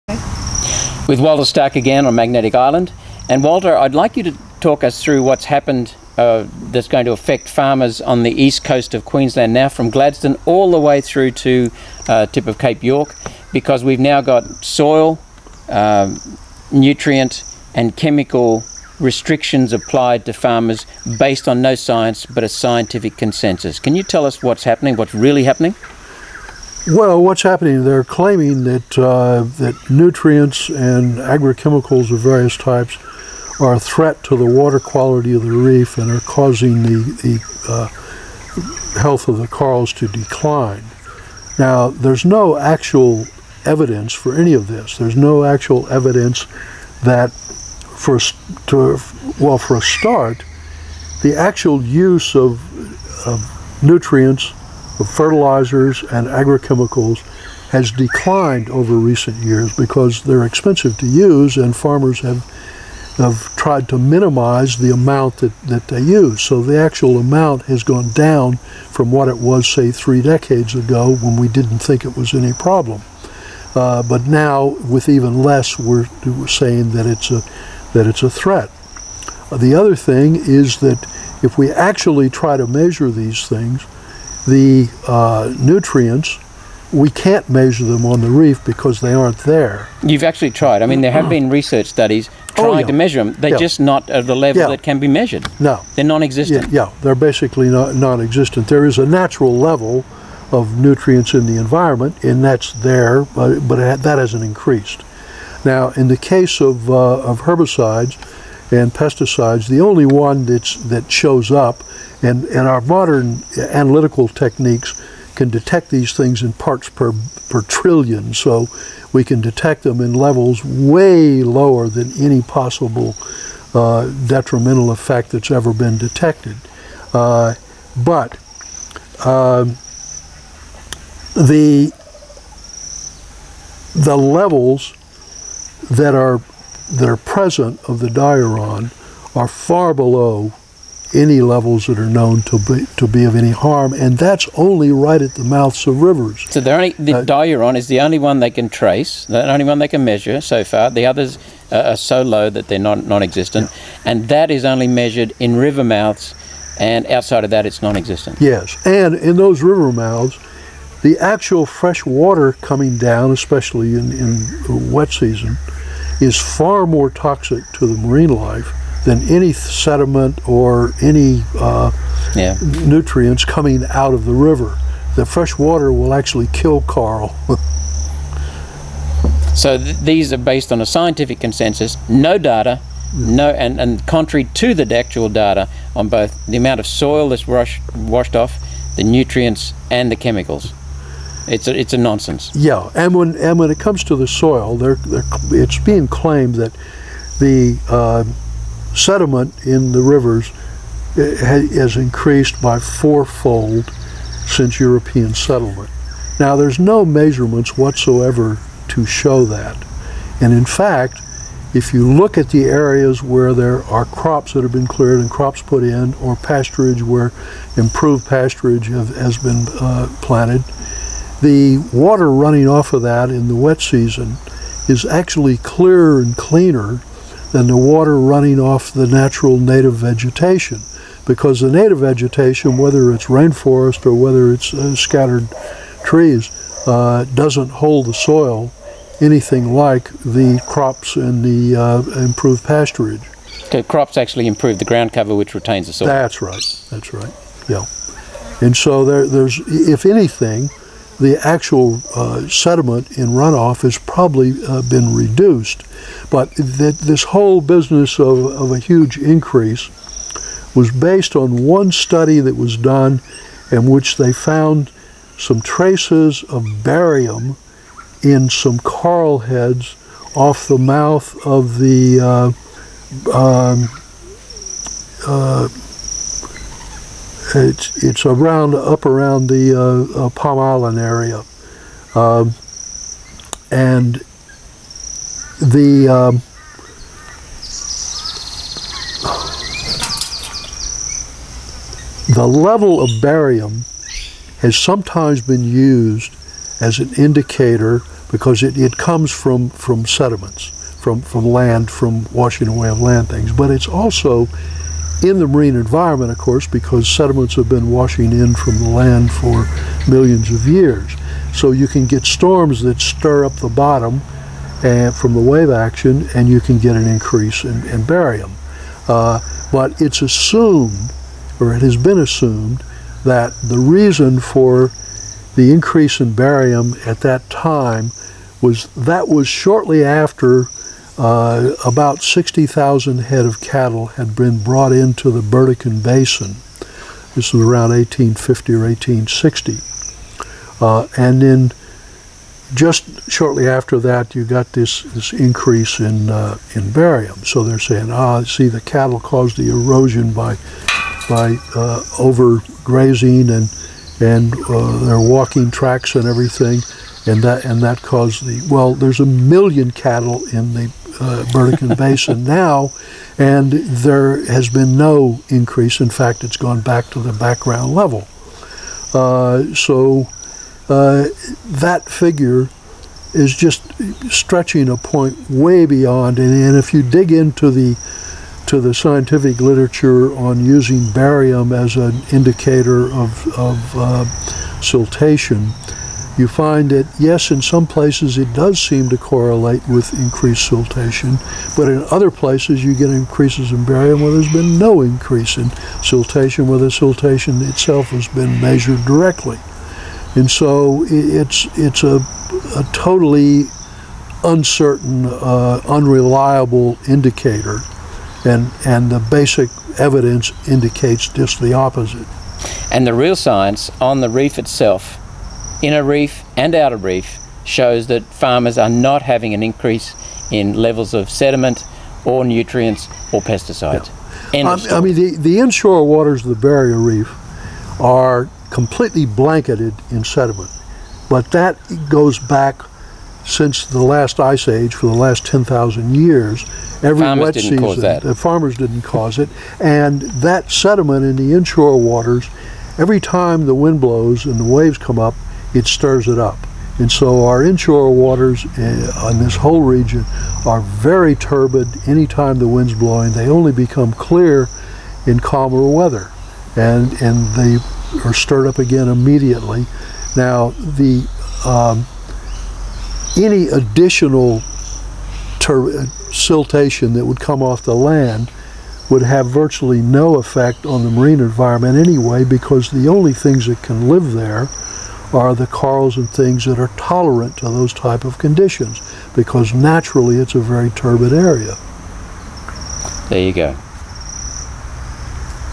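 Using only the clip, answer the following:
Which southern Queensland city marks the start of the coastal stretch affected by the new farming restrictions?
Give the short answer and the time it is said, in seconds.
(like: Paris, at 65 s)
Gladstone, at 9 s.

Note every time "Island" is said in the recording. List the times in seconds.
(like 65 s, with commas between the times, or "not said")
2 s, 280 s.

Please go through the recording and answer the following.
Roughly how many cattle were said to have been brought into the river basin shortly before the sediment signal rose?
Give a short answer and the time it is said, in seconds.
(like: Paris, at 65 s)
60,000, at 332 s.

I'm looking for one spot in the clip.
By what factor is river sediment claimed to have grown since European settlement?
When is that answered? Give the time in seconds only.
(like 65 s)
202 s.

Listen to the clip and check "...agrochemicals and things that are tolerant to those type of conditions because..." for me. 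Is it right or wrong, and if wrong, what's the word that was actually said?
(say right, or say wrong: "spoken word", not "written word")
wrong: "corals", not "agrochemicals".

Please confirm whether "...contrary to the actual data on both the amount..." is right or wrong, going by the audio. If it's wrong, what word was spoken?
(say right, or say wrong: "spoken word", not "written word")
right.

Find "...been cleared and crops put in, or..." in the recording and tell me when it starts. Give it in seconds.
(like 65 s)
214 s.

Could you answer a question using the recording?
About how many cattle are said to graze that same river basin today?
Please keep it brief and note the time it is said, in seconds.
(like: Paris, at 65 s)
1 million, at 359 s.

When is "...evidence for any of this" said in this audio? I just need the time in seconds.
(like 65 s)
43 s.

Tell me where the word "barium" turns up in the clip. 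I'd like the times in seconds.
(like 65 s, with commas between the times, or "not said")
266 s, 293 s, 318 s, 326 s, 346 s, 381 s, 393 s.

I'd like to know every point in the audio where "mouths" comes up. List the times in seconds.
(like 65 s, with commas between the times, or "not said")
145 s, 155 s, 159 s, 270 s.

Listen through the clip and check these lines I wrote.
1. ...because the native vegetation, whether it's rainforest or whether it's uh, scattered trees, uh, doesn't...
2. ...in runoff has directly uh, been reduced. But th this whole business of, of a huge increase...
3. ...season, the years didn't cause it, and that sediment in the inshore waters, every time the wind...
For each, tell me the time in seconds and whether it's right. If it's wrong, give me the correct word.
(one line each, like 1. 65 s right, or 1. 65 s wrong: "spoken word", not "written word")
1. 231 s right
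2. 253 s wrong: "probably", not "directly"
3. 437 s wrong: "farmers", not "years".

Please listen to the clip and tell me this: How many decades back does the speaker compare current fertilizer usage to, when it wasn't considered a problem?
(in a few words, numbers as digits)
3.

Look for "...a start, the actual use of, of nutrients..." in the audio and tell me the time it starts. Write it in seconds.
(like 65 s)
49 s.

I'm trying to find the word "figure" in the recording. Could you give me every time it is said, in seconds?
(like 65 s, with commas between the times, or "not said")
372 s.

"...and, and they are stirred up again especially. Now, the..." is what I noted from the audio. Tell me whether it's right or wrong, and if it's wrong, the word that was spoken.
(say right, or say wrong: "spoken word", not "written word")
wrong: "immediately", not "especially".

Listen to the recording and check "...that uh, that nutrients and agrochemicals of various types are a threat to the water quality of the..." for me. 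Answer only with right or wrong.
right.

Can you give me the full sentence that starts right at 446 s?
And so our inshore waters eh, on this whole region are very turbid anytime the wind's blowing.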